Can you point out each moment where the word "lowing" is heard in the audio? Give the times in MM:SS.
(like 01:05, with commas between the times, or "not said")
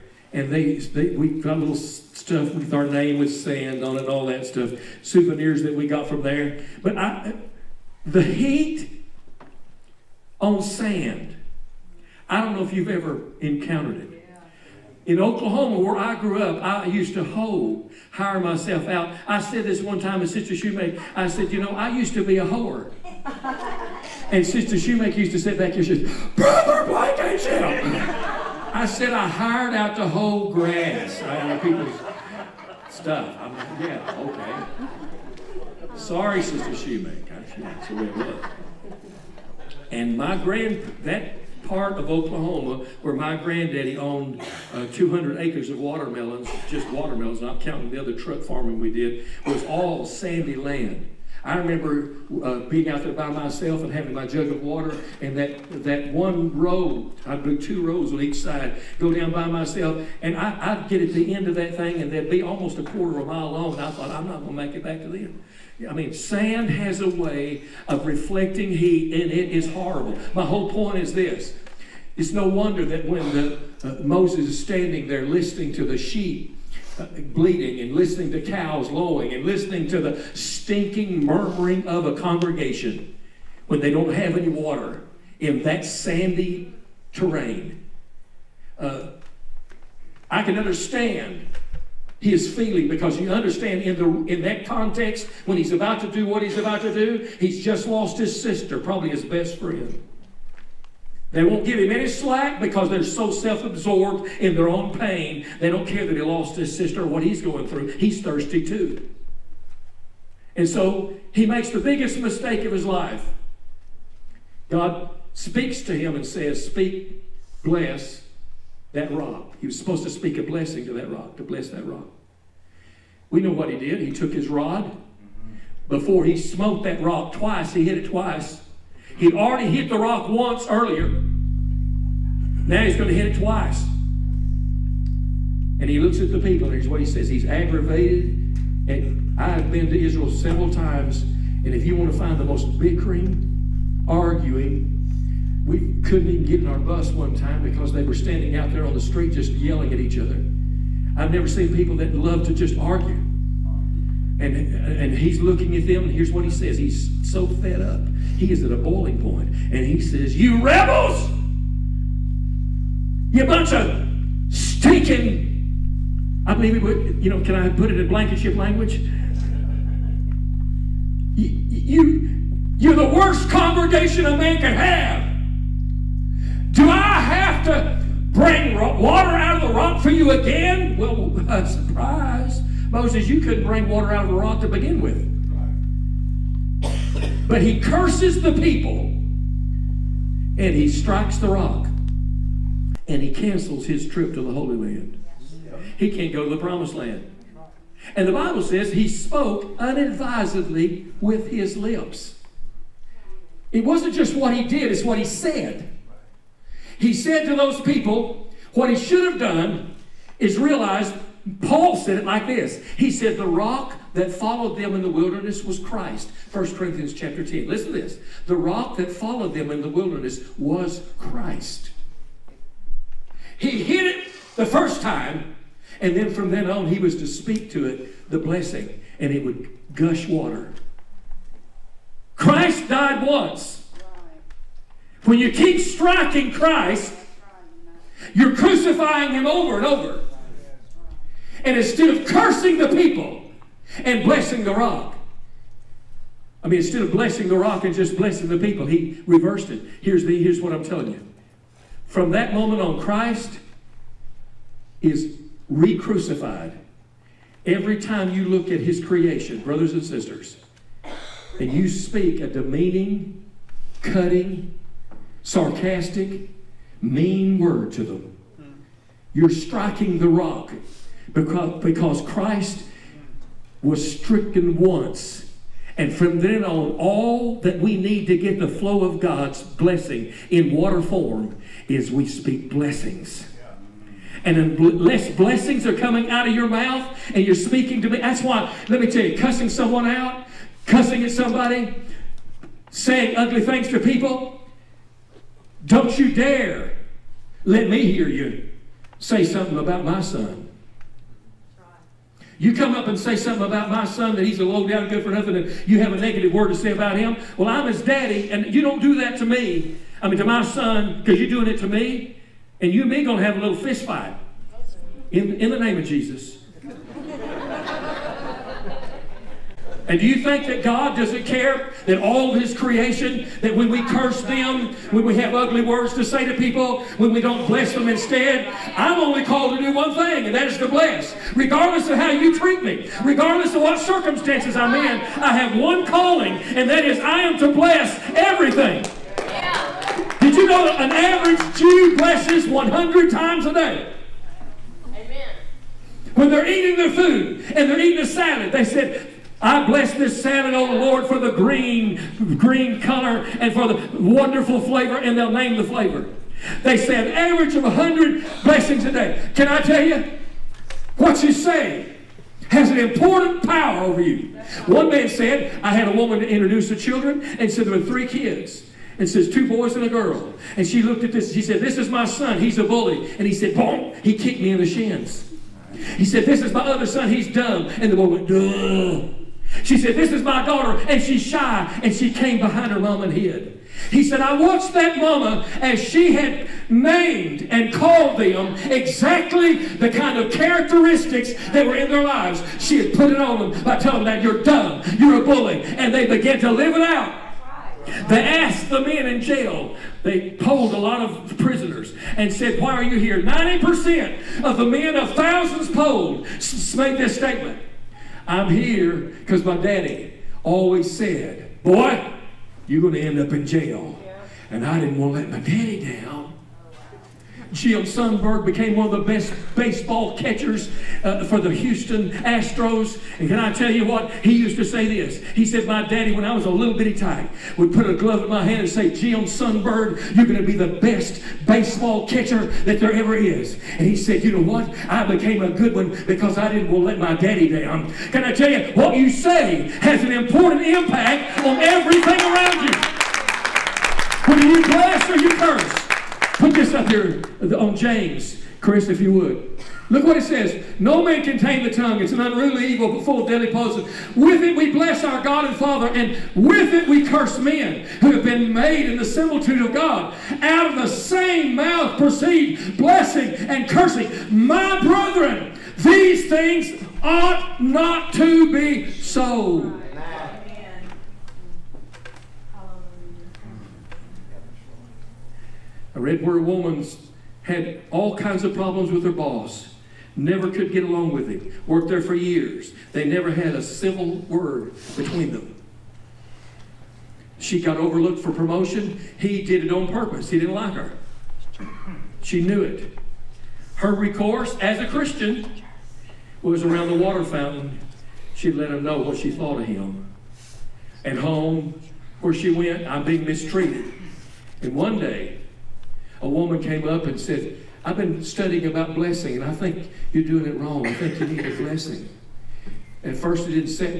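01:18.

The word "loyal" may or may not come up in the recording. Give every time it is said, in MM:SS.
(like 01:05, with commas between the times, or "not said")
not said.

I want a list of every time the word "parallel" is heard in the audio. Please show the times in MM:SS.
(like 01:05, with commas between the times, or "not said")
not said.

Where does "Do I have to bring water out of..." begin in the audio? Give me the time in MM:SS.
02:56.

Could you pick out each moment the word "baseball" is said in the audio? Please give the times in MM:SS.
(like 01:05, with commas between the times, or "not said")
06:59, 07:11.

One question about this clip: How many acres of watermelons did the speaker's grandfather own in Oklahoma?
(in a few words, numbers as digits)
200.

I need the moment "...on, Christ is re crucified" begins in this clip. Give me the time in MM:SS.
04:12.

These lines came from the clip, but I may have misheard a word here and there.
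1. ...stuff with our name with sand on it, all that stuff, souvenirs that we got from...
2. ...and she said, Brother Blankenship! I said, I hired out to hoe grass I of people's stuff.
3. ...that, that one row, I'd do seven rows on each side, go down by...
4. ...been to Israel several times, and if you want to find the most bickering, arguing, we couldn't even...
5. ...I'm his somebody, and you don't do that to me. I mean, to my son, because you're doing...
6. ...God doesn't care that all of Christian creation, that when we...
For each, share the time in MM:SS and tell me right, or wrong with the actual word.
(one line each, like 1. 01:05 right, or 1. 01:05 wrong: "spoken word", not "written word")
1. 00:01 right
2. 00:25 right
3. 00:55 wrong: "two", not "seven"
4. 02:19 right
5. 05:07 wrong: "daddy", not "somebody"
6. 05:20 wrong: "His", not "Christian".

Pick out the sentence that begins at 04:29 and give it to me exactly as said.
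You're striking the rock because, because Christ was stricken once.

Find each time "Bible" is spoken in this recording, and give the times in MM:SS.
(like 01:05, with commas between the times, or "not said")
03:18.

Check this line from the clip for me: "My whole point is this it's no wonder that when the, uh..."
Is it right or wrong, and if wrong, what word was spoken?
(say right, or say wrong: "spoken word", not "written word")
right.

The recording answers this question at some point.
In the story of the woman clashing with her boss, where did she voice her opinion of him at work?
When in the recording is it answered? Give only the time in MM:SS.
08:17.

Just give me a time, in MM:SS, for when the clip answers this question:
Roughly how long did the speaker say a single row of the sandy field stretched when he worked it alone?
01:02.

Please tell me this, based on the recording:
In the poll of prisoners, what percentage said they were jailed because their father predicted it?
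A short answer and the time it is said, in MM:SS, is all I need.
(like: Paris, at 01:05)
90%, at 06:43.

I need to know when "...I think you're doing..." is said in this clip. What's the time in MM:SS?
08:29.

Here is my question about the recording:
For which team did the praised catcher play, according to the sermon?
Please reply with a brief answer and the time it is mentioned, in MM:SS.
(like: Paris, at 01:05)
Houston Astros, at 07:01.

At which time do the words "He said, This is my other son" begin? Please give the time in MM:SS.
06:16.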